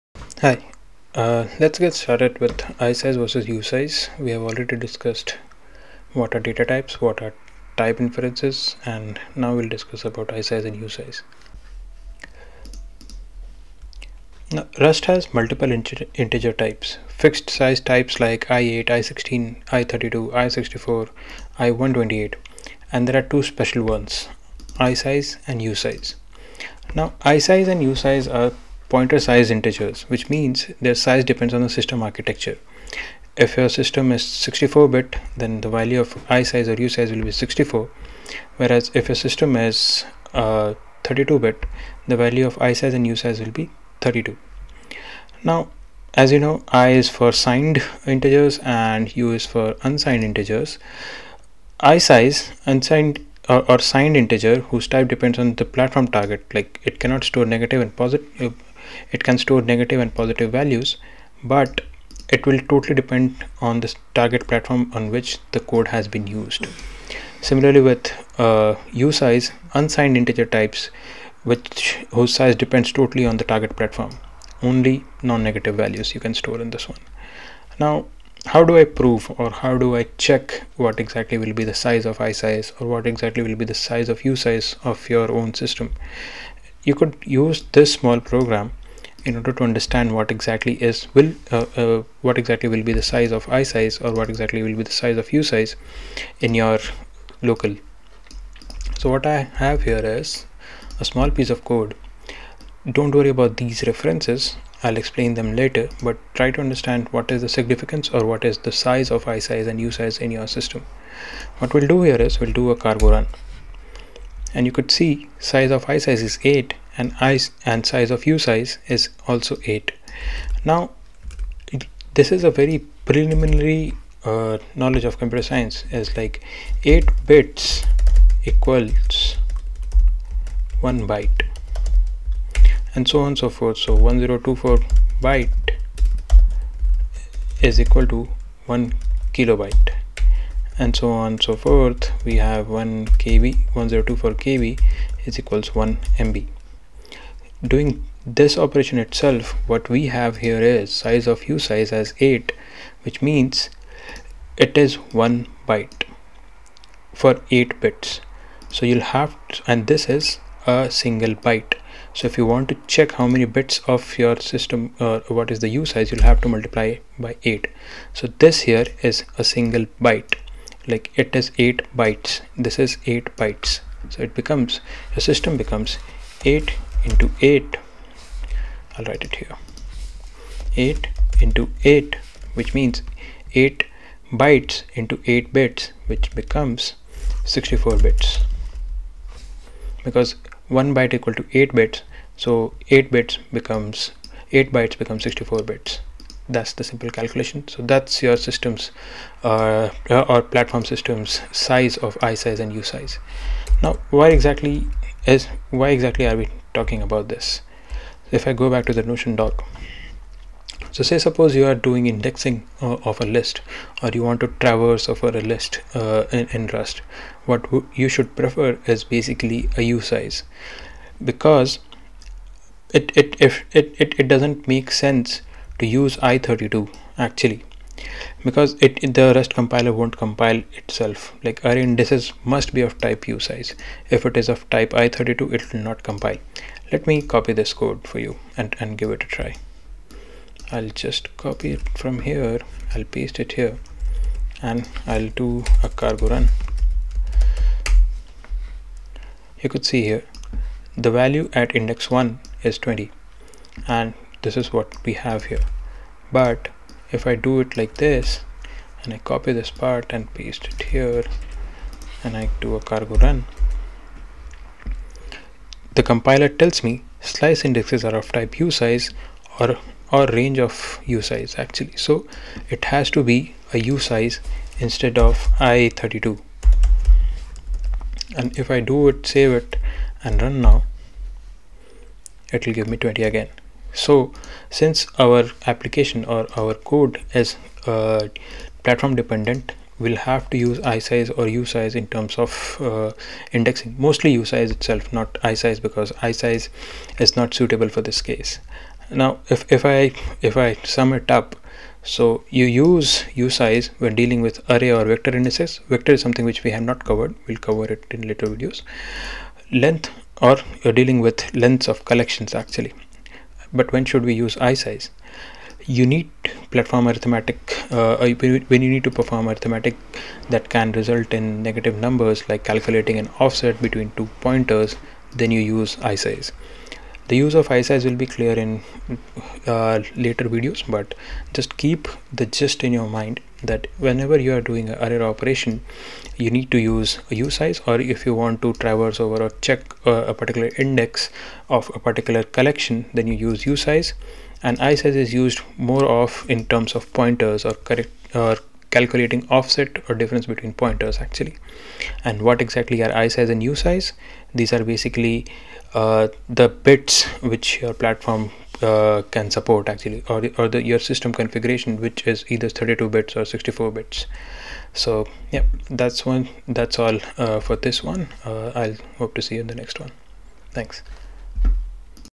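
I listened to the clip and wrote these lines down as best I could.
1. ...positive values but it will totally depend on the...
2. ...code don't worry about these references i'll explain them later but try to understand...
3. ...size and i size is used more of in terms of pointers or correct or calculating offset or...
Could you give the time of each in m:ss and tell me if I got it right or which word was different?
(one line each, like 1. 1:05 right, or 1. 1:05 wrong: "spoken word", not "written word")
1. 1:00 right
2. 1:41 right
3. 5:43 right.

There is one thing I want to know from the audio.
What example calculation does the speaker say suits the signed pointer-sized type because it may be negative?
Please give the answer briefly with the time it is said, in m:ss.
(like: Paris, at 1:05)
offset between two pointers, at 5:23.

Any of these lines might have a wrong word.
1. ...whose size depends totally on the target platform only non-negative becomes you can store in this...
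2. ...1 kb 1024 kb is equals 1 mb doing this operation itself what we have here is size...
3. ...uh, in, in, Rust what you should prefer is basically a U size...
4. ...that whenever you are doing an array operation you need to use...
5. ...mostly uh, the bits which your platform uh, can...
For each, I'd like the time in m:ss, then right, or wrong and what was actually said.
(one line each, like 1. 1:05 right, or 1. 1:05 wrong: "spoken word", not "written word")
1. 1:12 wrong: "values", not "becomes"
2. 2:22 right
3. 3:35 right
4. 5:33 right
5. 5:54 wrong: "basically", not "mostly".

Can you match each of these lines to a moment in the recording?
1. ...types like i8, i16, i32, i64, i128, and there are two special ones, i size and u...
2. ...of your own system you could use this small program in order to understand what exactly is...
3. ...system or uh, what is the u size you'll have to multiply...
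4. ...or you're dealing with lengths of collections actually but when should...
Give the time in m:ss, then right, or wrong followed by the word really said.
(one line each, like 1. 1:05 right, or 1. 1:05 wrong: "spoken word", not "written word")
1. 0:17 right
2. 1:24 right
3. 2:44 right
4. 5:10 right.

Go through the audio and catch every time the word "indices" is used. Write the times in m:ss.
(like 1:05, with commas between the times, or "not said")
3:51, 5:05.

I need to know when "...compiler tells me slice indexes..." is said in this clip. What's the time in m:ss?
4:26.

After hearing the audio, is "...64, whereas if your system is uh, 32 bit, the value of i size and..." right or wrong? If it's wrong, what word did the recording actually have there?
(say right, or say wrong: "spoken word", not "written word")
right.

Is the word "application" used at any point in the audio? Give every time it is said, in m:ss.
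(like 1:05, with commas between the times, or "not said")
4:45.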